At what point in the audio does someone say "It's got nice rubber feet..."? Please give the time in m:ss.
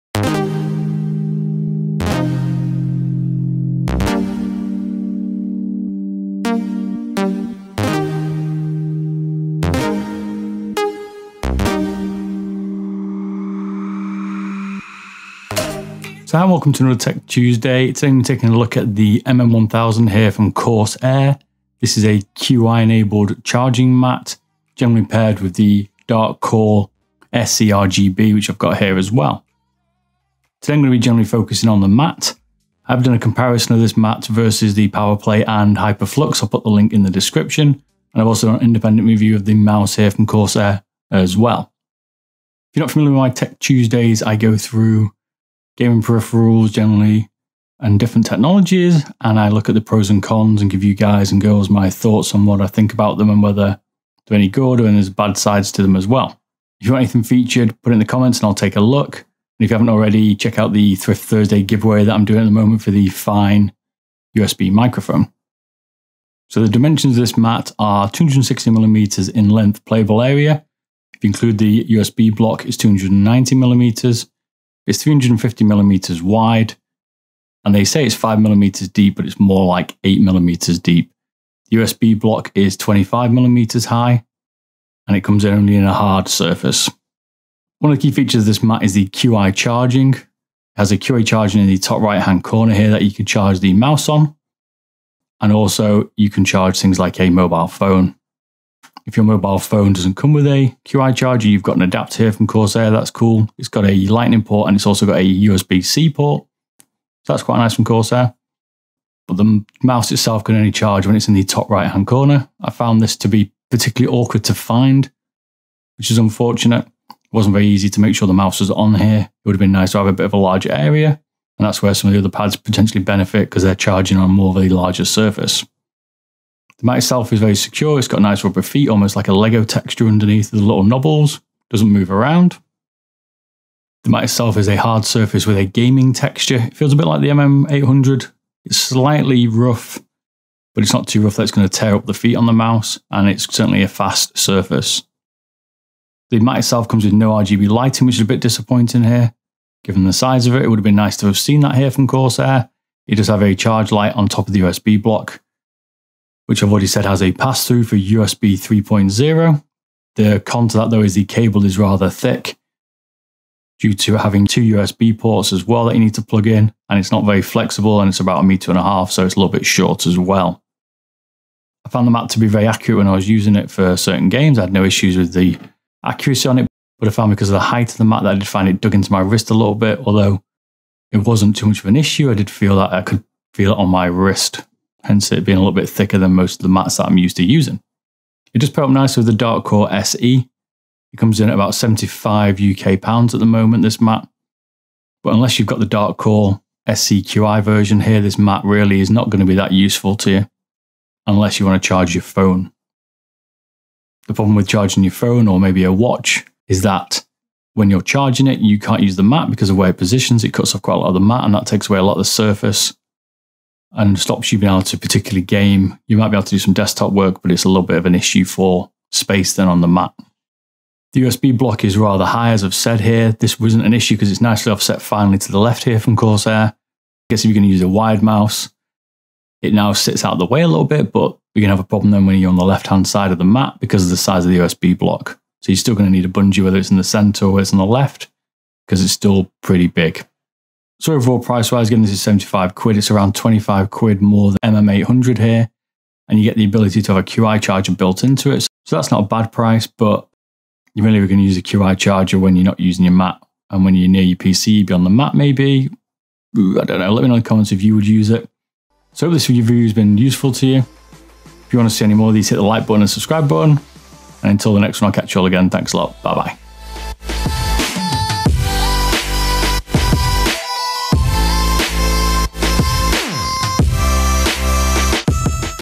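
2:07.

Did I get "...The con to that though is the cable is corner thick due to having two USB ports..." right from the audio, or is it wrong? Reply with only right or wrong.
wrong.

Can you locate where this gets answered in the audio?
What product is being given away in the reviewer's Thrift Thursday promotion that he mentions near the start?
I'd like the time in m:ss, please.
1:03.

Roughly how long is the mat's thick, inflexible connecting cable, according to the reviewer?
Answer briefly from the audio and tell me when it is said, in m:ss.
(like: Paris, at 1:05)
about a meter and a half, at 2:48.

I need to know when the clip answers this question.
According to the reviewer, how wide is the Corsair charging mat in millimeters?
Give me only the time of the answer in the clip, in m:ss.
1:15.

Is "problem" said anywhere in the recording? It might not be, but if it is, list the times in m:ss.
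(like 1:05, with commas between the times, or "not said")
3:24, 3:51.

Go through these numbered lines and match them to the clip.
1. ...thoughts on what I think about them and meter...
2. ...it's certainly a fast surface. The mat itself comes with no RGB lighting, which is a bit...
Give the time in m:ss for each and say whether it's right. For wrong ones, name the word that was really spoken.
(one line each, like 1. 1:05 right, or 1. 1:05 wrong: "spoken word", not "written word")
1. 0:51 wrong: "whether", not "meter"
2. 2:23 right.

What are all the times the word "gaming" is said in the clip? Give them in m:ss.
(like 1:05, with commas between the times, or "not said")
0:45, 2:15.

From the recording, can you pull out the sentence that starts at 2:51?
I found the map to be very accurate when I was using it for certain games.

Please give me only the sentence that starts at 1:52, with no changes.
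I found this to be particularly awkward to find, which is unfortunate.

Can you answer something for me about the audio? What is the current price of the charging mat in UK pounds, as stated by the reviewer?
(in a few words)
75 UK pounds.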